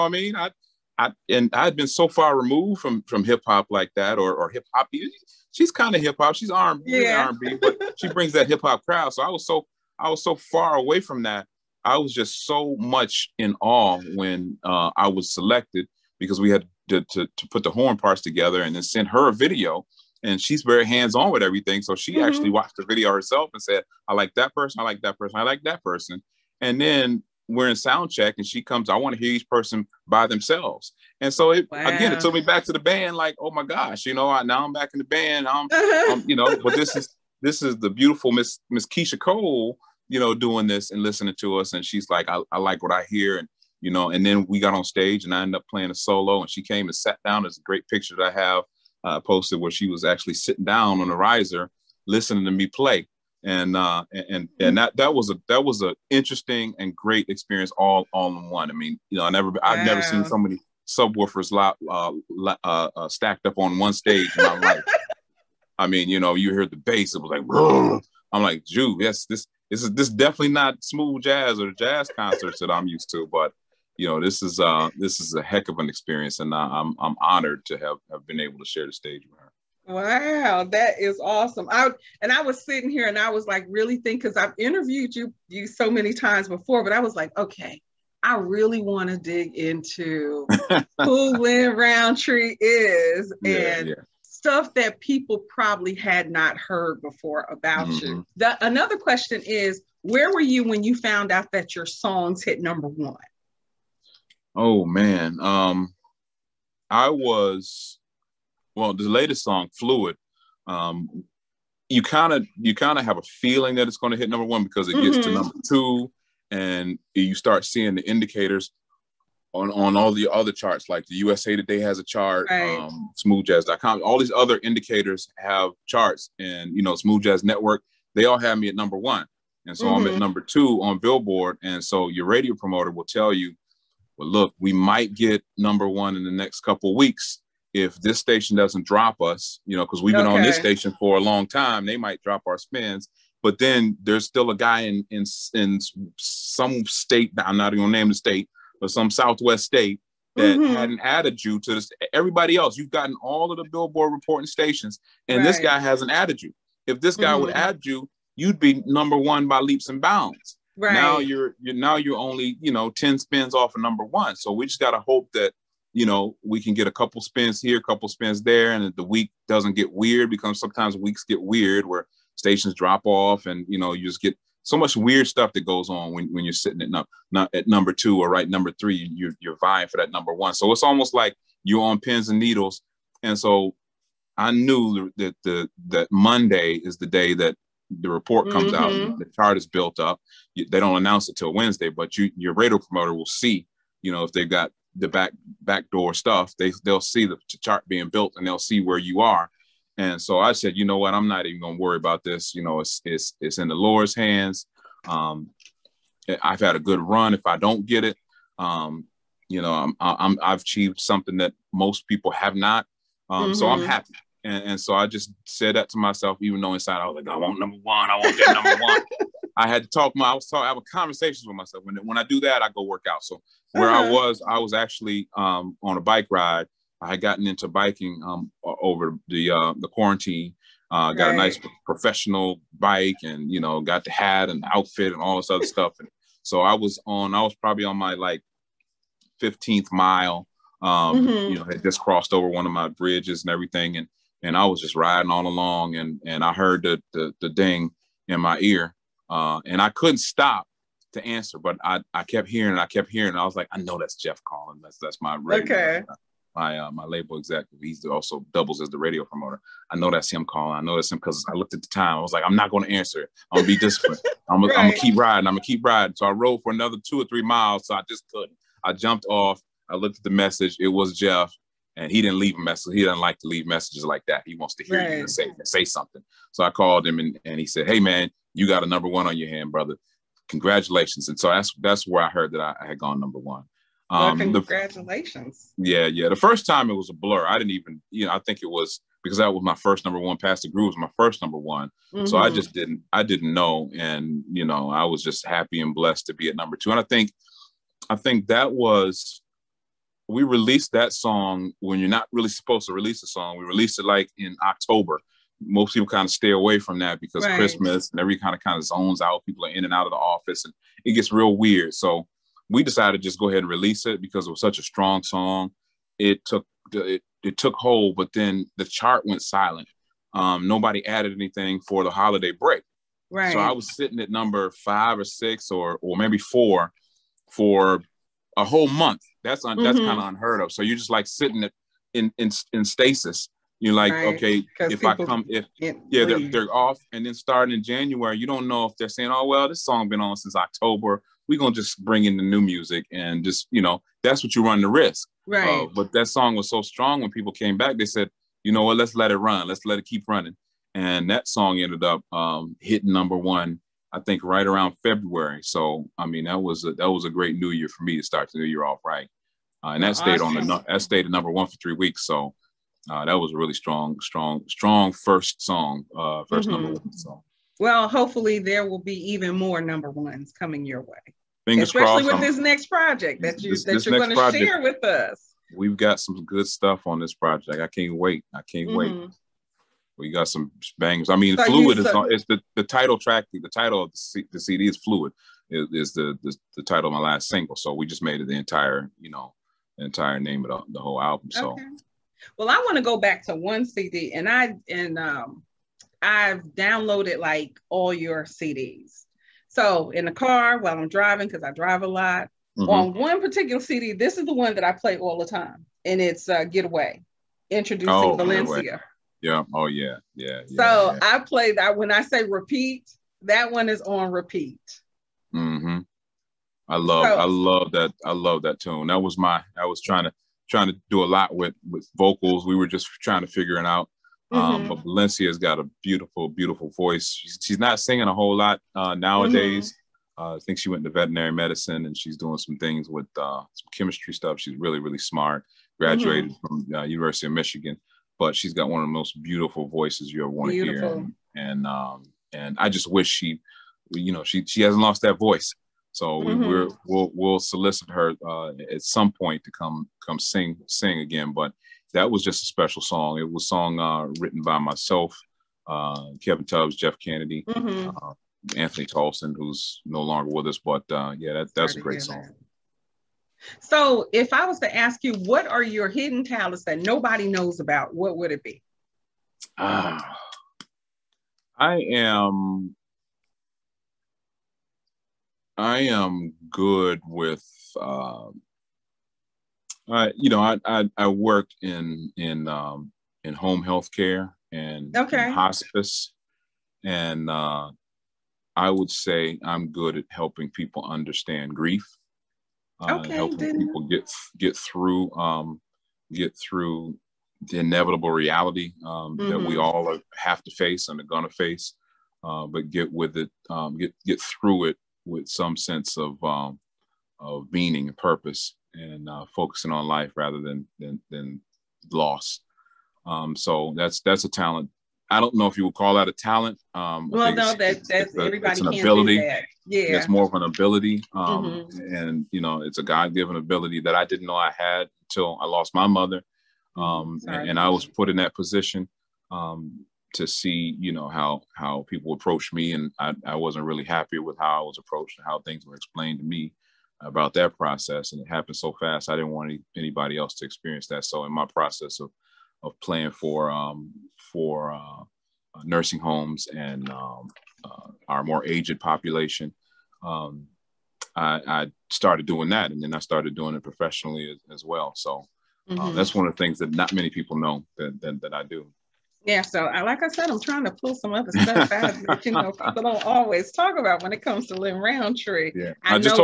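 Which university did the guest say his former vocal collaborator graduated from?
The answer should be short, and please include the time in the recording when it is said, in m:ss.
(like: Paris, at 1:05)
University of Michigan, at 7:17.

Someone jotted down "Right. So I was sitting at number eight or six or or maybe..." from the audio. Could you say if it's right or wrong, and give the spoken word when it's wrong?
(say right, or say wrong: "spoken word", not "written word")
wrong: "five", not "eight".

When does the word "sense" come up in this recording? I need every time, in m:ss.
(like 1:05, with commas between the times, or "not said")
8:25.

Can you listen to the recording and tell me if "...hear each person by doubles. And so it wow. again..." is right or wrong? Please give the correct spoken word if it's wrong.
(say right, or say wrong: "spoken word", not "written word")
wrong: "themselves", not "doubles".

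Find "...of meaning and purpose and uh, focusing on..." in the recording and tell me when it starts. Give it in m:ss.
8:27.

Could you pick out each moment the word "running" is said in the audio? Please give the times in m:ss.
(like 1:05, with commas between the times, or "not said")
5:50.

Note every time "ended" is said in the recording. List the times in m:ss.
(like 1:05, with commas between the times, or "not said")
0:45, 5:51.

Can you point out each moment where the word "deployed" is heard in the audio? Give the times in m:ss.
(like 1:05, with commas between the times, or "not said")
not said.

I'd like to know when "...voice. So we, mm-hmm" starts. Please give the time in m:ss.
7:25.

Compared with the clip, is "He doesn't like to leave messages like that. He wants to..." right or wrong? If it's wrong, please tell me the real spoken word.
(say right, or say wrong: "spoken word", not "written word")
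right.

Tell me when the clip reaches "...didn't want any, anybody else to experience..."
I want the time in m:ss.
8:59.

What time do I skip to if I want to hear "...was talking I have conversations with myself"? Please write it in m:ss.
3:40.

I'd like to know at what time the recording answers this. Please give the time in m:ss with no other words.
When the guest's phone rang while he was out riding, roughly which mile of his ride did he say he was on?
3:59.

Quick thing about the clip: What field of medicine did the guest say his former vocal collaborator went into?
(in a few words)
Veterinary medicine.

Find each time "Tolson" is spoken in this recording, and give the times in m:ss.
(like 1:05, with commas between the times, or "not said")
7:39.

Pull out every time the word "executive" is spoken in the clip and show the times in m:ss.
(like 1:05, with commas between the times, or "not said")
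4:17.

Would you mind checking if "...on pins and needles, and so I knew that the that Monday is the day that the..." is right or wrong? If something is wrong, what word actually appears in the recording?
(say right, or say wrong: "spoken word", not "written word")
right.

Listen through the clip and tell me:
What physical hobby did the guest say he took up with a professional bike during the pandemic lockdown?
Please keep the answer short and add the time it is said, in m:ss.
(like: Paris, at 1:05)
Biking, at 3:47.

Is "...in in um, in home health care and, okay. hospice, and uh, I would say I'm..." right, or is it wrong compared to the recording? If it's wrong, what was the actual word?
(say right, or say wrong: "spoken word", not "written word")
right.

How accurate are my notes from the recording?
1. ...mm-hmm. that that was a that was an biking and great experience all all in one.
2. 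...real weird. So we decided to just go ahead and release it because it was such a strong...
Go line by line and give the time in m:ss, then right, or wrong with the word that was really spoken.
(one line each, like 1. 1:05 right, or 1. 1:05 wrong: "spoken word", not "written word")
1. 0:54 wrong: "interesting", not "biking"
2. 5:11 right.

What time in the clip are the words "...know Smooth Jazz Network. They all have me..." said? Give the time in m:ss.
2:06.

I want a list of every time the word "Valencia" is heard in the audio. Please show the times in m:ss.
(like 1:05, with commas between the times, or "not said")
6:48, 7:05.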